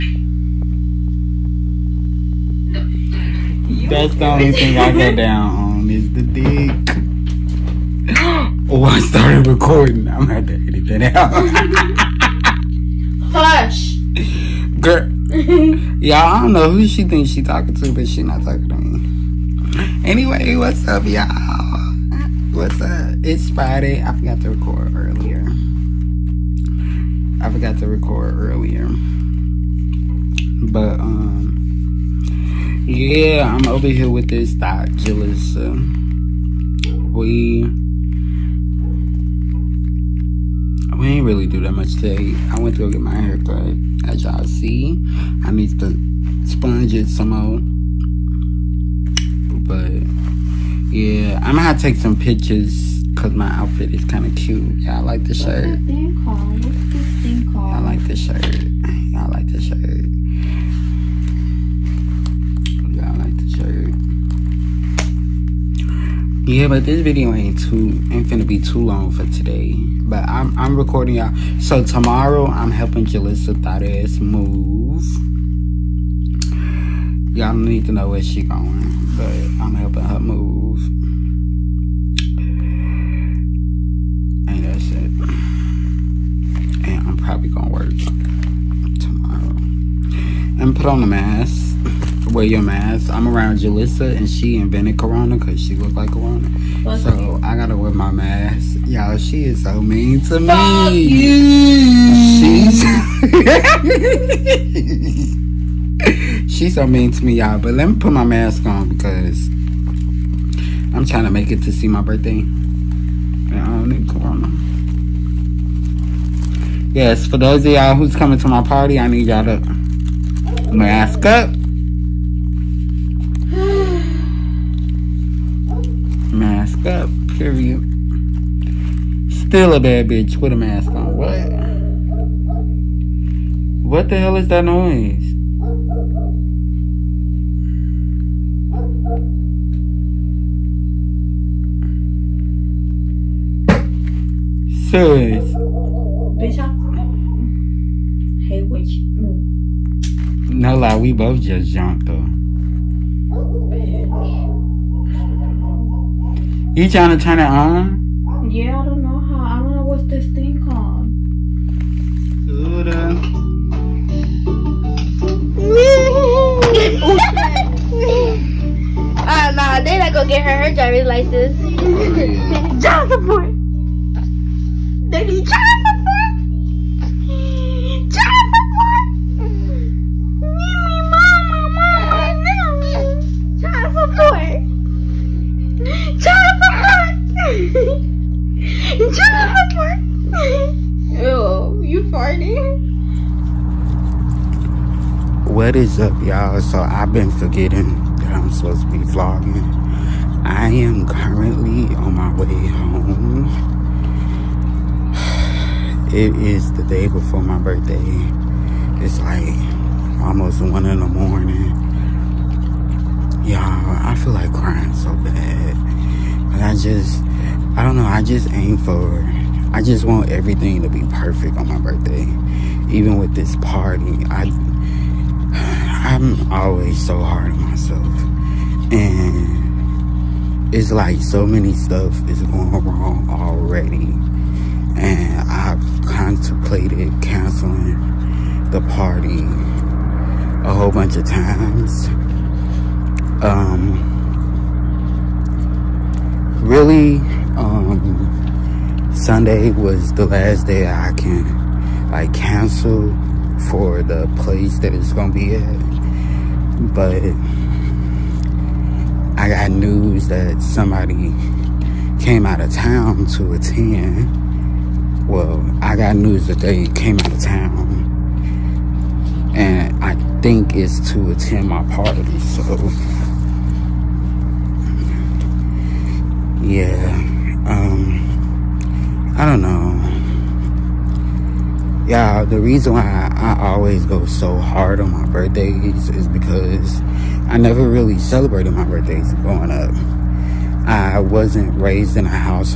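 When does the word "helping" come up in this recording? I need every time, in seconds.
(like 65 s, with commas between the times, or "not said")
72 s, 79 s.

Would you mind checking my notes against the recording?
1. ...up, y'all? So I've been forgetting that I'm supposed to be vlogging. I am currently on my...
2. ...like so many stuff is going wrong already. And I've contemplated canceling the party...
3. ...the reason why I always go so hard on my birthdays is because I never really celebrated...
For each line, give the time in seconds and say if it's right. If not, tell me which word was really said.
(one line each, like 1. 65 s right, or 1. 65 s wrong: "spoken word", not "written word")
1. 195 s right
2. 230 s right
3. 282 s right.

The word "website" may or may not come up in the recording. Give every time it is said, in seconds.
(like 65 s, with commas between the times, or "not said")
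not said.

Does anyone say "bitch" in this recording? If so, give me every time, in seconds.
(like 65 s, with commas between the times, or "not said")
130 s, 146 s, 153 s.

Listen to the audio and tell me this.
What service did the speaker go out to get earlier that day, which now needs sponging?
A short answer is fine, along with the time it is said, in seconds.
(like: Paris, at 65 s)
Haircut, at 43 s.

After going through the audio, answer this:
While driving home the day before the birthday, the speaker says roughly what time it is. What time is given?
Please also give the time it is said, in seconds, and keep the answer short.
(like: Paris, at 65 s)
Almost 1 in the morning, at 210 s.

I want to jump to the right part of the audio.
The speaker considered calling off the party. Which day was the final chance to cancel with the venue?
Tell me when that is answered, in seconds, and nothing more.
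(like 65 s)
249 s.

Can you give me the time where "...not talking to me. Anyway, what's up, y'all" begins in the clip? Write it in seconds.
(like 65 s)
18 s.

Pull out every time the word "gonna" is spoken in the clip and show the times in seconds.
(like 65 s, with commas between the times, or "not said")
10 s, 51 s, 68 s, 87 s, 170 s, 255 s.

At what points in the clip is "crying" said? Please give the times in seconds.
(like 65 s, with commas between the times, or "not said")
214 s.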